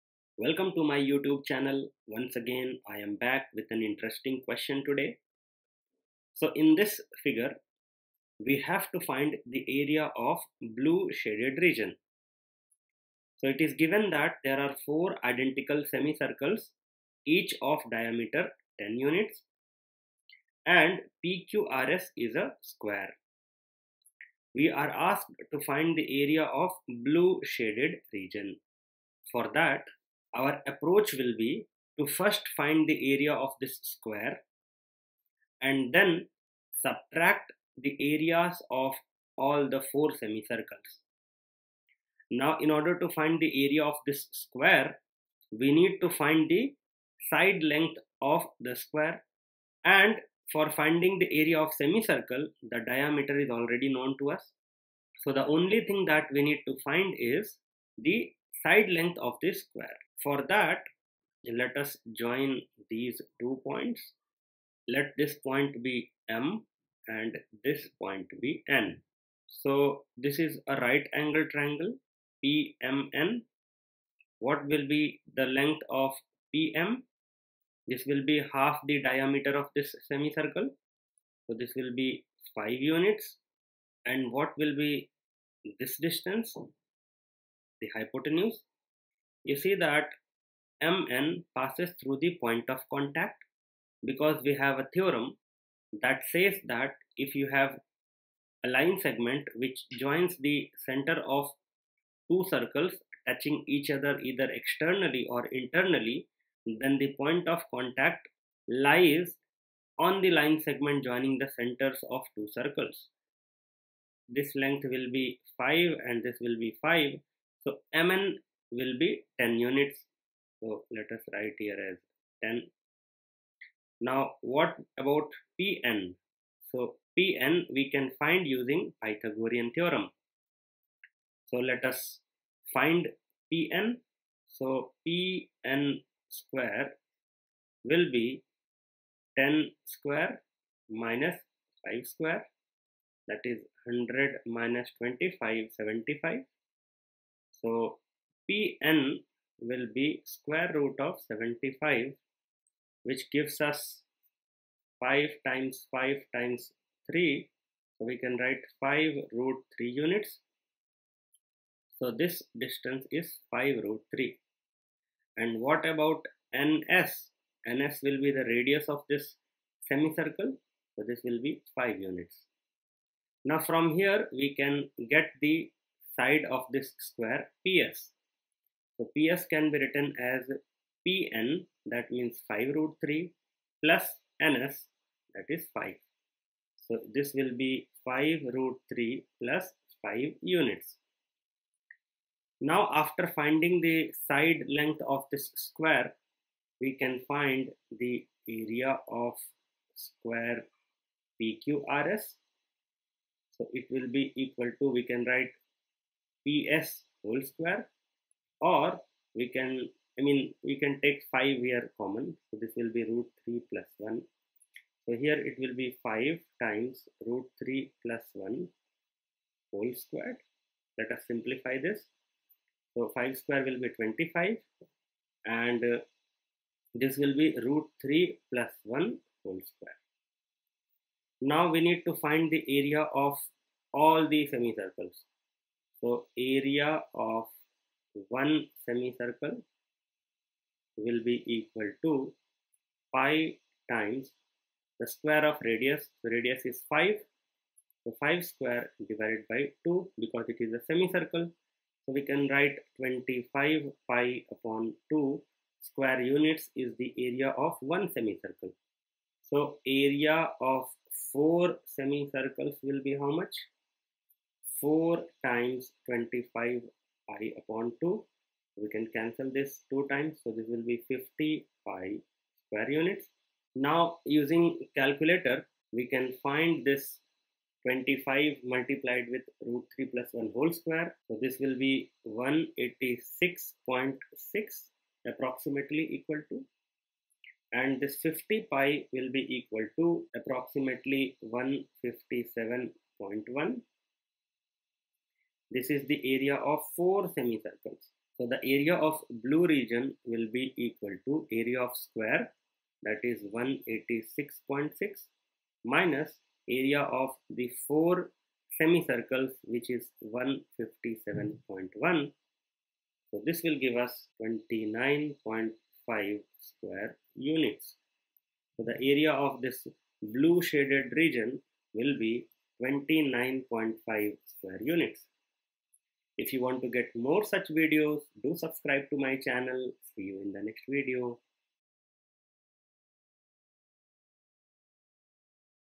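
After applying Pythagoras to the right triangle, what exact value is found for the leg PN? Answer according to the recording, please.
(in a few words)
5 root 3.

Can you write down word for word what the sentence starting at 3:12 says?
Now after finding the side length of this square, we can find the area of square PQRS.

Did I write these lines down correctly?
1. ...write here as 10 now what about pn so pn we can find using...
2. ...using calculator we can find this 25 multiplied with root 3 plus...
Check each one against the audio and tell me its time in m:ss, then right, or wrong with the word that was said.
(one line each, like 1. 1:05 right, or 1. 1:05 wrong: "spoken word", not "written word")
1. 2:01 right
2. 4:34 right.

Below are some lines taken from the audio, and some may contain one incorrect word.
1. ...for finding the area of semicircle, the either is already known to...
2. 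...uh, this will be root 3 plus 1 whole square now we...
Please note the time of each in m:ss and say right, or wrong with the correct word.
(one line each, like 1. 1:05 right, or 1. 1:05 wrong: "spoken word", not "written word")
1. 0:50 wrong: "diameter", not "either"
2. 3:45 right.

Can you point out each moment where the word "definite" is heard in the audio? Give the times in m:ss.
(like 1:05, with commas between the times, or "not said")
not said.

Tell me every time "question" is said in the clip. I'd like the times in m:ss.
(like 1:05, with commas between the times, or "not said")
0:04.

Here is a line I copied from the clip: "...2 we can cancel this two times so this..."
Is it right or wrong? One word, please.
right.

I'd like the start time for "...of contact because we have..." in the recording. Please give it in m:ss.
1:32.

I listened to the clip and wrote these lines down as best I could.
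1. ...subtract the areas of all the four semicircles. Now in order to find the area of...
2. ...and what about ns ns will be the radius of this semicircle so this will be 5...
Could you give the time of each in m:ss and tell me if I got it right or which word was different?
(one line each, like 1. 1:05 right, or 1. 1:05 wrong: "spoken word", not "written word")
1. 0:36 right
2. 2:45 right.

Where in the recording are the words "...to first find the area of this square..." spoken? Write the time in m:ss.
0:31.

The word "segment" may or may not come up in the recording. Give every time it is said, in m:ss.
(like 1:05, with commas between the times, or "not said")
1:39, 1:50.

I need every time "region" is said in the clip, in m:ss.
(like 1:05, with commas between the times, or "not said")
0:11, 0:28, 4:59, 5:21.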